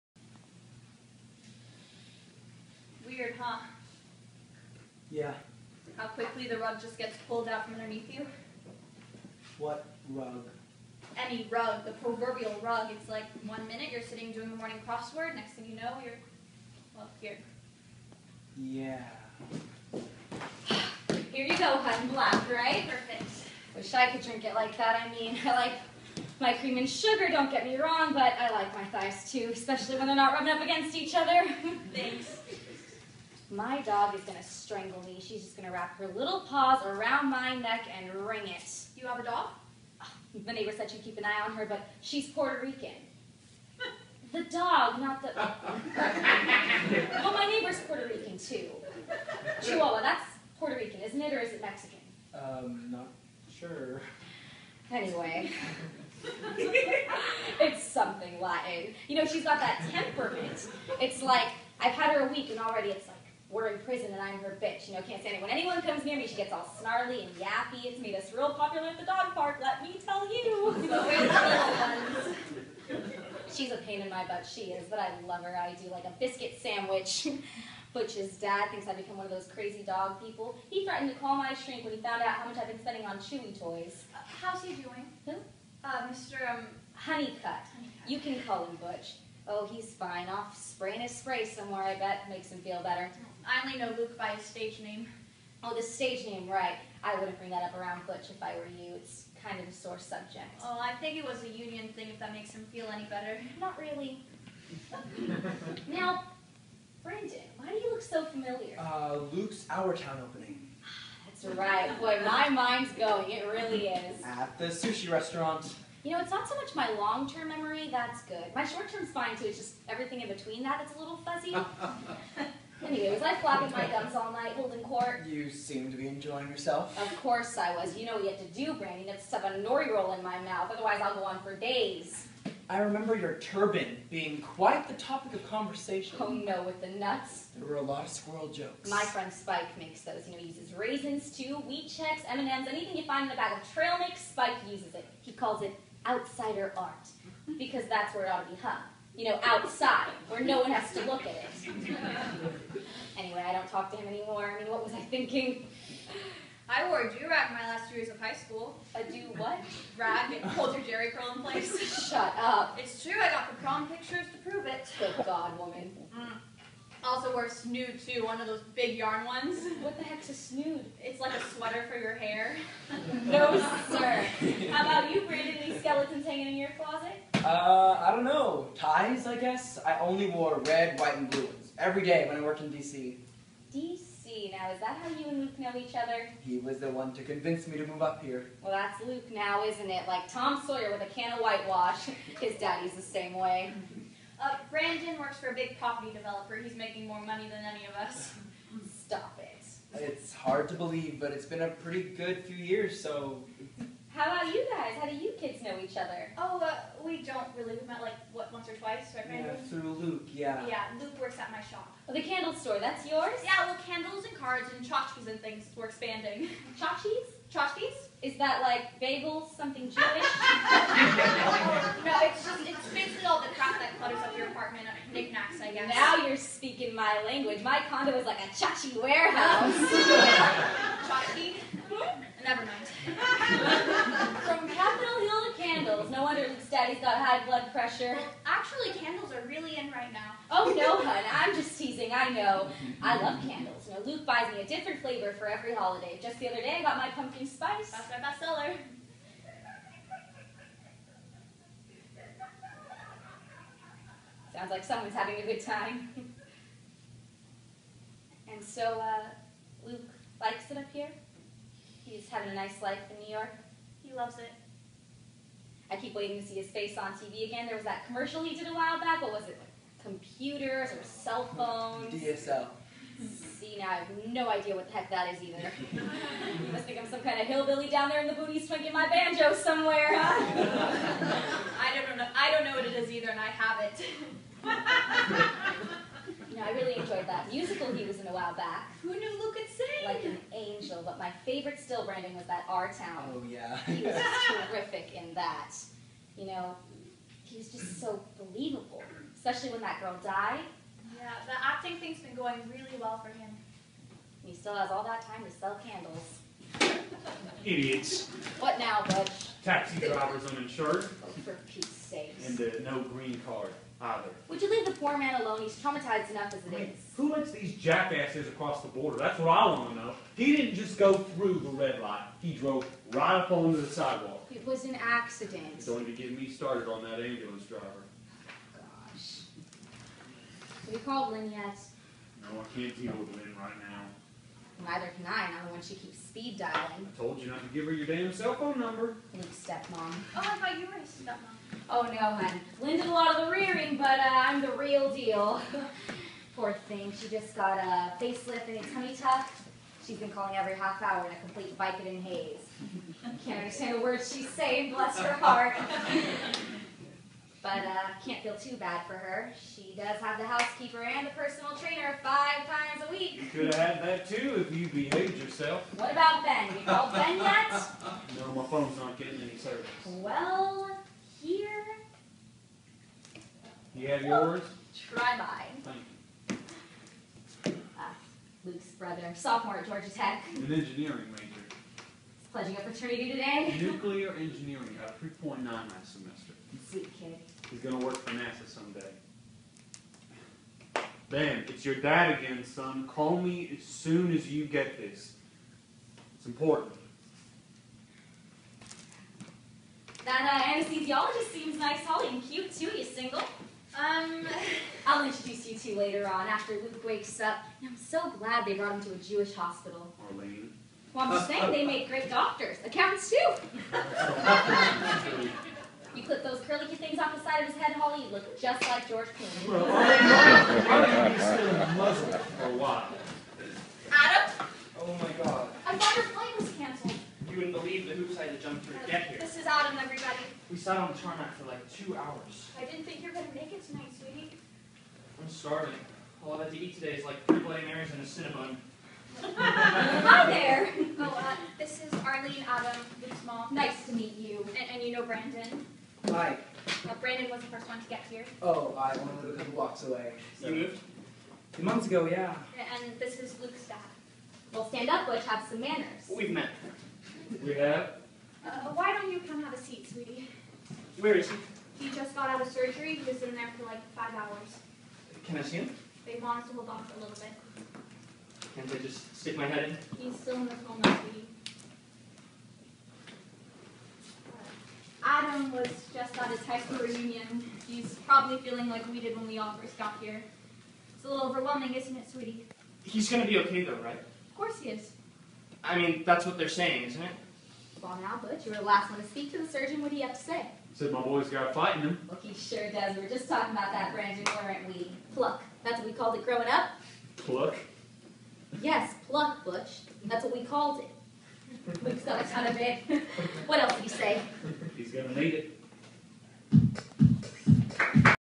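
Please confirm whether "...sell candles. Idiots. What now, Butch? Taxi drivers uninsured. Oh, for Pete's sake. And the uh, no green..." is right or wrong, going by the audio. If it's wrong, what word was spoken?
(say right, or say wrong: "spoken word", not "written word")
right.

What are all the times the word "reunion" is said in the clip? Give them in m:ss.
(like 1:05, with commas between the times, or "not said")
7:57.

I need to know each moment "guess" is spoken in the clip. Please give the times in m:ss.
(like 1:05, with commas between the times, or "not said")
2:59, 3:45.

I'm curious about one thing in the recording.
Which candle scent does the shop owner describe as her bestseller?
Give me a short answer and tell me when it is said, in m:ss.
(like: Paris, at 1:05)
pumpkin spice, at 4:07.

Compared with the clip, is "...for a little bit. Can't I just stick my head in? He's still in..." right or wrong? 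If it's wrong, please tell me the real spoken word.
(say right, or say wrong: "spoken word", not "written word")
right.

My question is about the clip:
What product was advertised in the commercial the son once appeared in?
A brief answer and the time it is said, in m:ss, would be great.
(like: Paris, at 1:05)
DSL, at 4:32.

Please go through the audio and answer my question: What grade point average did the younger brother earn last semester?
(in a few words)
3.9.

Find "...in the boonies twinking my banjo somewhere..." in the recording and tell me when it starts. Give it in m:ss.
4:38.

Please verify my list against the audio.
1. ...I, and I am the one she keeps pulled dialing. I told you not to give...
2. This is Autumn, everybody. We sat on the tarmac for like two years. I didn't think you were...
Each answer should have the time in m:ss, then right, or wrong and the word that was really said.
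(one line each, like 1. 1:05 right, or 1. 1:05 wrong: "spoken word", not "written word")
1. 5:35 wrong: "speed", not "pulled"
2. 7:09 wrong: "hours", not "years".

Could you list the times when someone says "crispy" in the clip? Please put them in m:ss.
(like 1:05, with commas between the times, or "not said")
not said.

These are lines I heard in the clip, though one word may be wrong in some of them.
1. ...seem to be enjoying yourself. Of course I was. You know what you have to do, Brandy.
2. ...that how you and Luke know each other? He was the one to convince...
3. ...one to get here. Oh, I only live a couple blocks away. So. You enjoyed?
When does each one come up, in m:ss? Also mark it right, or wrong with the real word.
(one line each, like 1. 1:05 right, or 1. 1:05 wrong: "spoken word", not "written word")
1. 2:05 right
2. 3:04 right
3. 7:27 wrong: "moved", not "enjoyed".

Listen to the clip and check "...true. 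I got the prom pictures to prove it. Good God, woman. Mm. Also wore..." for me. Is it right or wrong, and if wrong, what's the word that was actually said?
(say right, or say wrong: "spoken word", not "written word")
right.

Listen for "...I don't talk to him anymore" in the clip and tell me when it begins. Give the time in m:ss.
2:33.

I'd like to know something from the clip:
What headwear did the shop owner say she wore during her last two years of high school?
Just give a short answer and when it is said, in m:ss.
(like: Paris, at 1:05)
do rag, at 2:37.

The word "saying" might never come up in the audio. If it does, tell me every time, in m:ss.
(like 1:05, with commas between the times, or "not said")
5:54, 6:51, 8:06.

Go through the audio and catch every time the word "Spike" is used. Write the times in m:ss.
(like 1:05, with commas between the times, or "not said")
2:19, 2:24.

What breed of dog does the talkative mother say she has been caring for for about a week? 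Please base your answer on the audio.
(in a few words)
Chihuahua.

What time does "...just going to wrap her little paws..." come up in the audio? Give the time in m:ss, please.
0:35.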